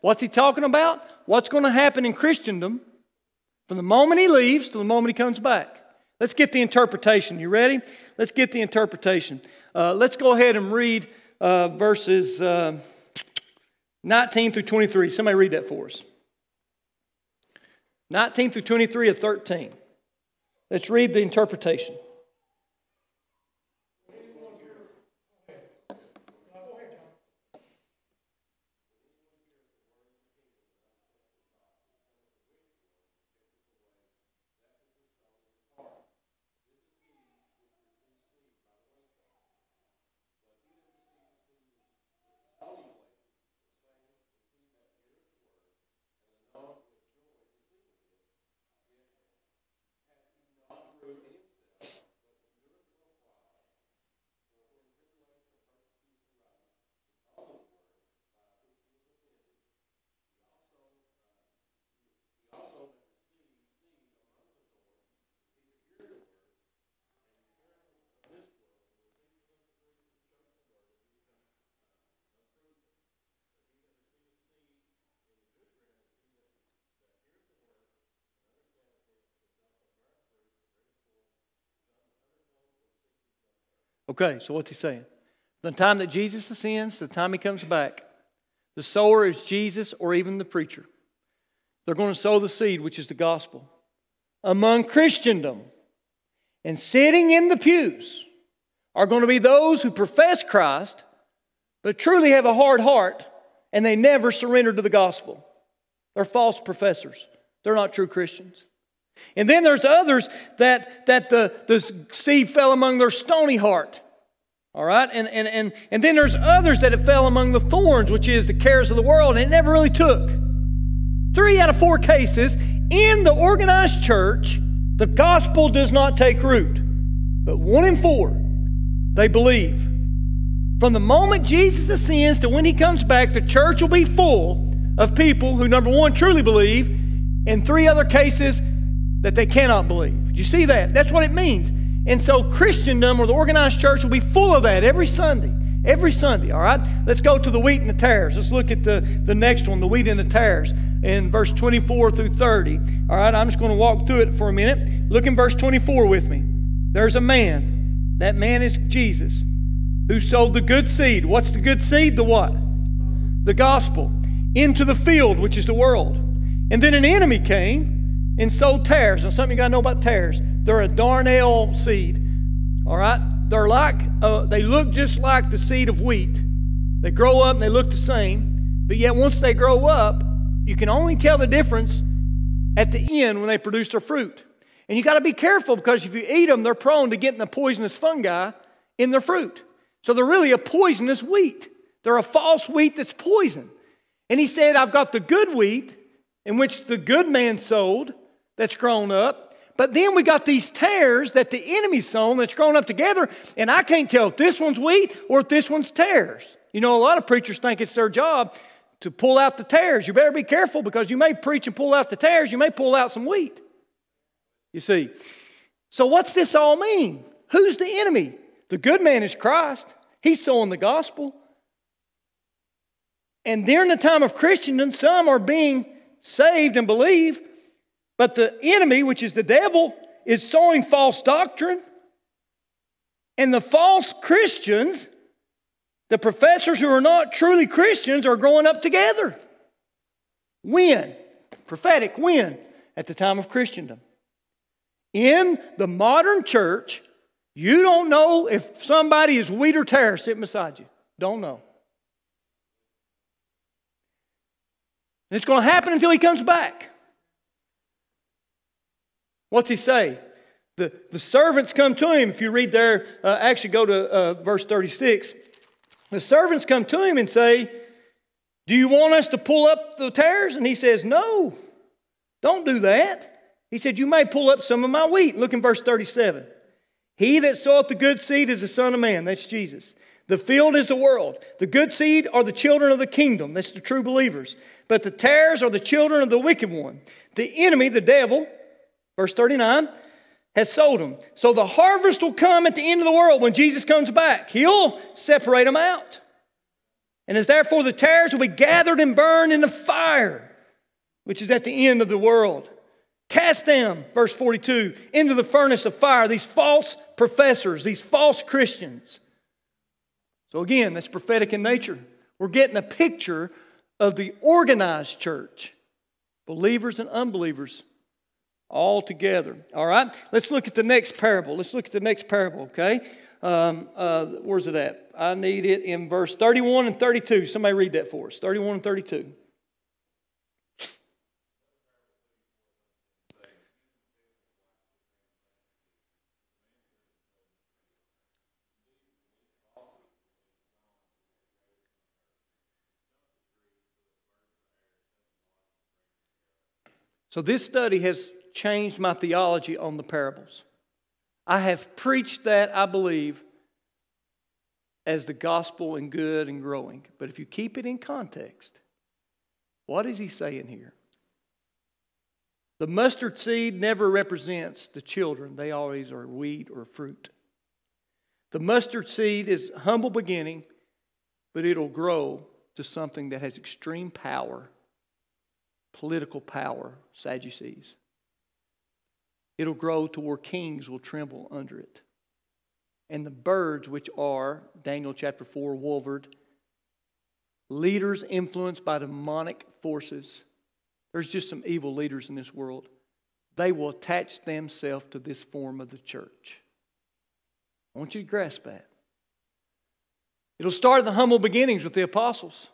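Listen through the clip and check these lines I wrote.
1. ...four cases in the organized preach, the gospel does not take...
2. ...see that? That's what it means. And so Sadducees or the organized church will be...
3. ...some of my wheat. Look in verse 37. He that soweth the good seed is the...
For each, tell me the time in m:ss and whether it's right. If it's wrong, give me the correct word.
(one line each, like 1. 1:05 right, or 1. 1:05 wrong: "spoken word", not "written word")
1. 2:01 wrong: "church", not "preach"
2. 2:20 wrong: "Christendom", not "Sadducees"
3. 4:34 right.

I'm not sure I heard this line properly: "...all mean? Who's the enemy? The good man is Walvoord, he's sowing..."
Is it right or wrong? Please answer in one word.
wrong.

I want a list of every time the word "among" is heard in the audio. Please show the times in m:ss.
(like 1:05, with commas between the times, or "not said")
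1:34, 1:52, 1:57.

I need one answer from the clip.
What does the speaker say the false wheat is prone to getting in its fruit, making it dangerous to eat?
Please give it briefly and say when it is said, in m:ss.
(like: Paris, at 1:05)
Poisonous fungi, at 3:07.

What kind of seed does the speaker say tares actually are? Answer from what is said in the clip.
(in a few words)
Darnel seed.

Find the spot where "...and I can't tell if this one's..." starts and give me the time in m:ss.
3:23.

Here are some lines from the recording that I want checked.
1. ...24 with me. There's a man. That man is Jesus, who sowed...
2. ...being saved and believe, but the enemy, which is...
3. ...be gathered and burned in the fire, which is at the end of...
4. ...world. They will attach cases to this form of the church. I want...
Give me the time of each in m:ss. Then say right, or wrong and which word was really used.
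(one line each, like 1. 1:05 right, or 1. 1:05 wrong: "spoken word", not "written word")
1. 2:35 right
2. 3:45 right
3. 4:58 right
4. 6:32 wrong: "themselves", not "cases".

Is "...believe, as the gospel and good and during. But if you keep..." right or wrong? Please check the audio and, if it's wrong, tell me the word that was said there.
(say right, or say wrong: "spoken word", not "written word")
wrong: "growing", not "during".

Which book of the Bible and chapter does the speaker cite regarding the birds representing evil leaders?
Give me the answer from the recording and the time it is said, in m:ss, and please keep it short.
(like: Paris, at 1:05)
Daniel chapter 4, at 6:24.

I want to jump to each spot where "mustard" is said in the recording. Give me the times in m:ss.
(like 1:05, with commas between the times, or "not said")
6:02, 6:08.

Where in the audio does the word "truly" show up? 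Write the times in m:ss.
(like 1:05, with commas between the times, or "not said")
1:41, 2:16, 3:57.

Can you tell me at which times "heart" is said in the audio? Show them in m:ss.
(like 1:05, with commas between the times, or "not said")
1:42, 1:53.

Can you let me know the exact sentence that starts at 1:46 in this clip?
They're false professors, they're not true Christians.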